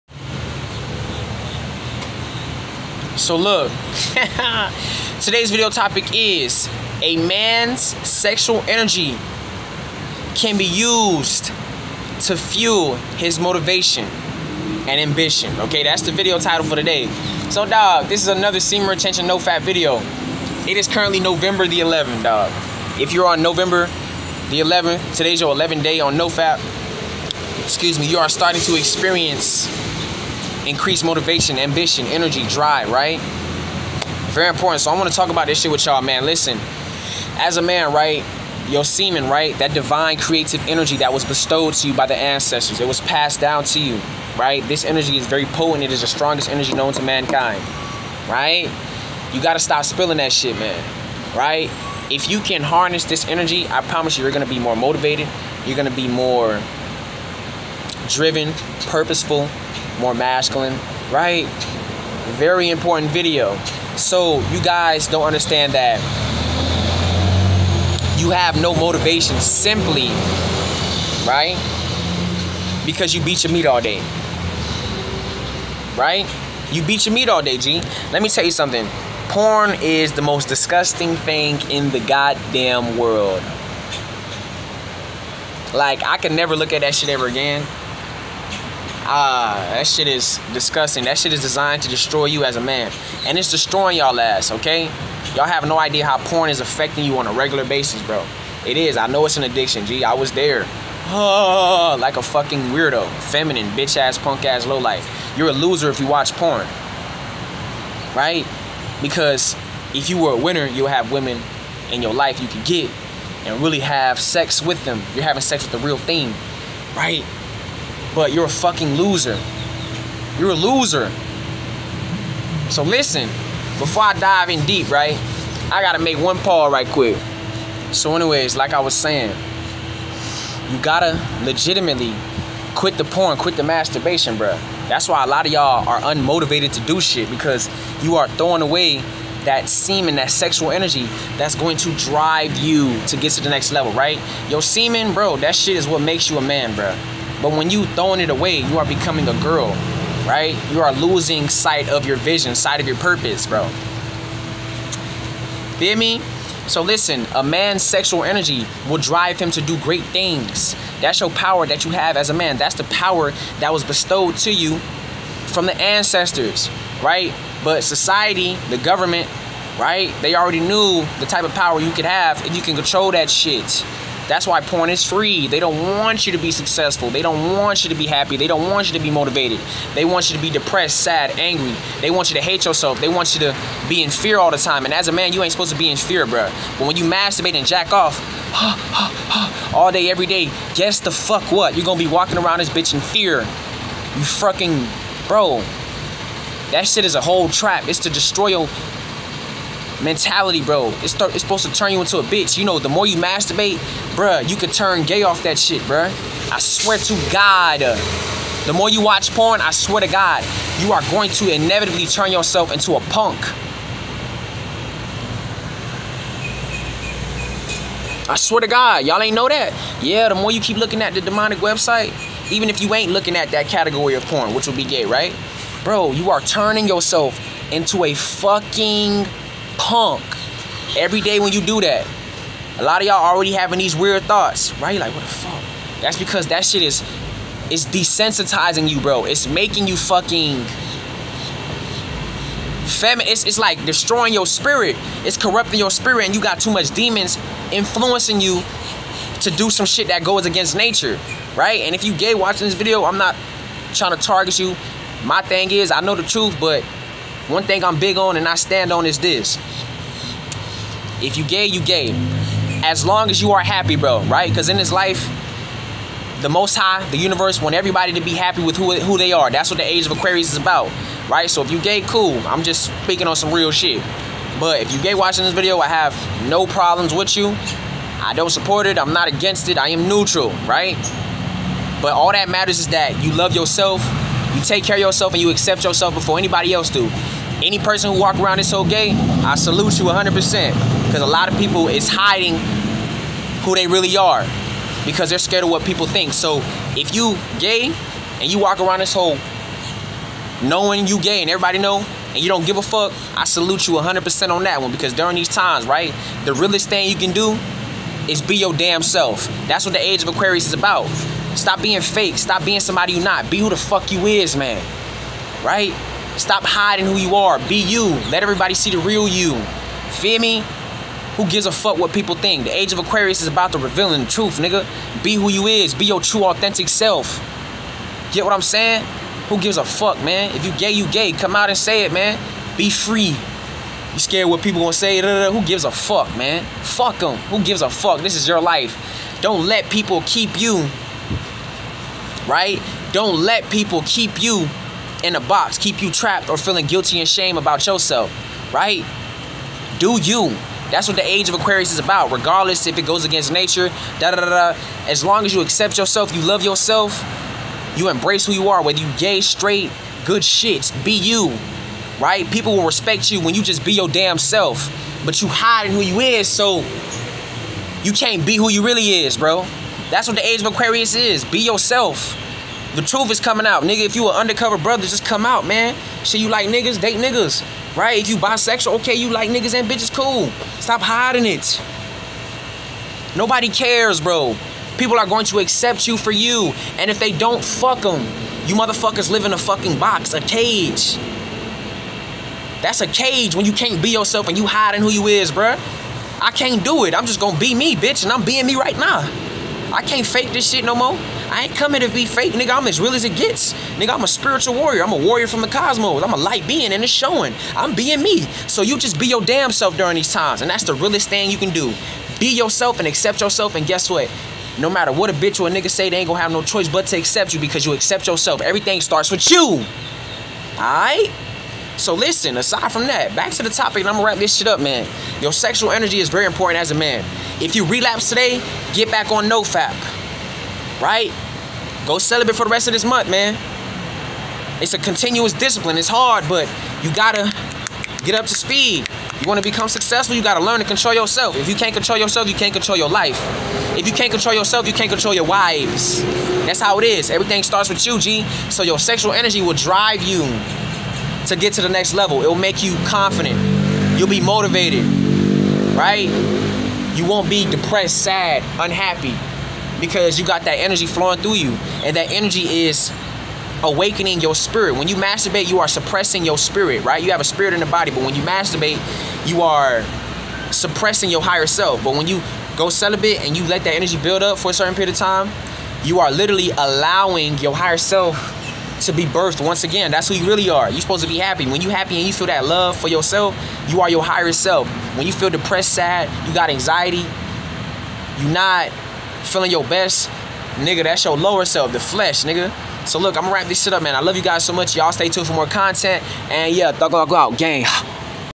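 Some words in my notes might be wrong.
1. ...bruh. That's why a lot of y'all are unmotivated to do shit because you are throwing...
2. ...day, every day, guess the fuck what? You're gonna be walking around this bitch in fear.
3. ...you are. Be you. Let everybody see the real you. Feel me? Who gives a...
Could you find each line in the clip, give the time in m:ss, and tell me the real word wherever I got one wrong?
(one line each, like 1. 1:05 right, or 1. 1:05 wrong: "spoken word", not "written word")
1. 2:14 right
2. 3:09 right
3. 5:17 right.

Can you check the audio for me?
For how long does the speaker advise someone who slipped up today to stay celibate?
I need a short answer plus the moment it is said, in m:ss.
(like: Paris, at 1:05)
rest of this month, at 7:12.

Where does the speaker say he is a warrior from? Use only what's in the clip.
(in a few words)
the cosmos.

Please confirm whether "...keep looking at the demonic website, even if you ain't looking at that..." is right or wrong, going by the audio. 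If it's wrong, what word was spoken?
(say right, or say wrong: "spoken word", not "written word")
right.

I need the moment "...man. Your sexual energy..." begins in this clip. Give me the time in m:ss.
7:04.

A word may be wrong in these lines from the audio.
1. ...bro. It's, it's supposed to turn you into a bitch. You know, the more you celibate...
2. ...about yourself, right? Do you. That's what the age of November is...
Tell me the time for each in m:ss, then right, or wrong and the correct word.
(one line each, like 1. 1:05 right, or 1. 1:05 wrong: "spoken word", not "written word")
1. 3:20 wrong: "masturbate", not "celibate"
2. 5:47 wrong: "Aquarius", not "November".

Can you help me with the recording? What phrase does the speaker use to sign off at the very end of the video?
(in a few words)
thug out, gang.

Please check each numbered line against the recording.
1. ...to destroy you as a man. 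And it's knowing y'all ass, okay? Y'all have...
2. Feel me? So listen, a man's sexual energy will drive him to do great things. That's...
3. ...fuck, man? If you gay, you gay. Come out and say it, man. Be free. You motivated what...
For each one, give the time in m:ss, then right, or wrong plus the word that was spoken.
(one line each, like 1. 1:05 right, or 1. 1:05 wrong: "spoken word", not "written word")
1. 1:31 wrong: "destroying", not "knowing"
2. 2:35 right
3. 5:29 wrong: "scared", not "motivated".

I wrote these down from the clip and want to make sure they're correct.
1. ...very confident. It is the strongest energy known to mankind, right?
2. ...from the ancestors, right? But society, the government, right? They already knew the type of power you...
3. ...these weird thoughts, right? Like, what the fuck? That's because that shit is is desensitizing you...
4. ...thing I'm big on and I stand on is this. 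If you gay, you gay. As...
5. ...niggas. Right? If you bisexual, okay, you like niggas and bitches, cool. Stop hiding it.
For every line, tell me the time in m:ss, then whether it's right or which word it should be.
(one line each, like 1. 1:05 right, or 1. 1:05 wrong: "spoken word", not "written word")
1. 0:45 wrong: "potent", not "confident"
2. 2:45 right
3. 3:53 right
4. 4:17 right
5. 6:17 right.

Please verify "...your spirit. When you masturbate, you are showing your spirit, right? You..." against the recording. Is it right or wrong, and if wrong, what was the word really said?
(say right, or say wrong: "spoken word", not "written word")
wrong: "suppressing", not "showing".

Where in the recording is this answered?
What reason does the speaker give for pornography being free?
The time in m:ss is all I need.
2:55.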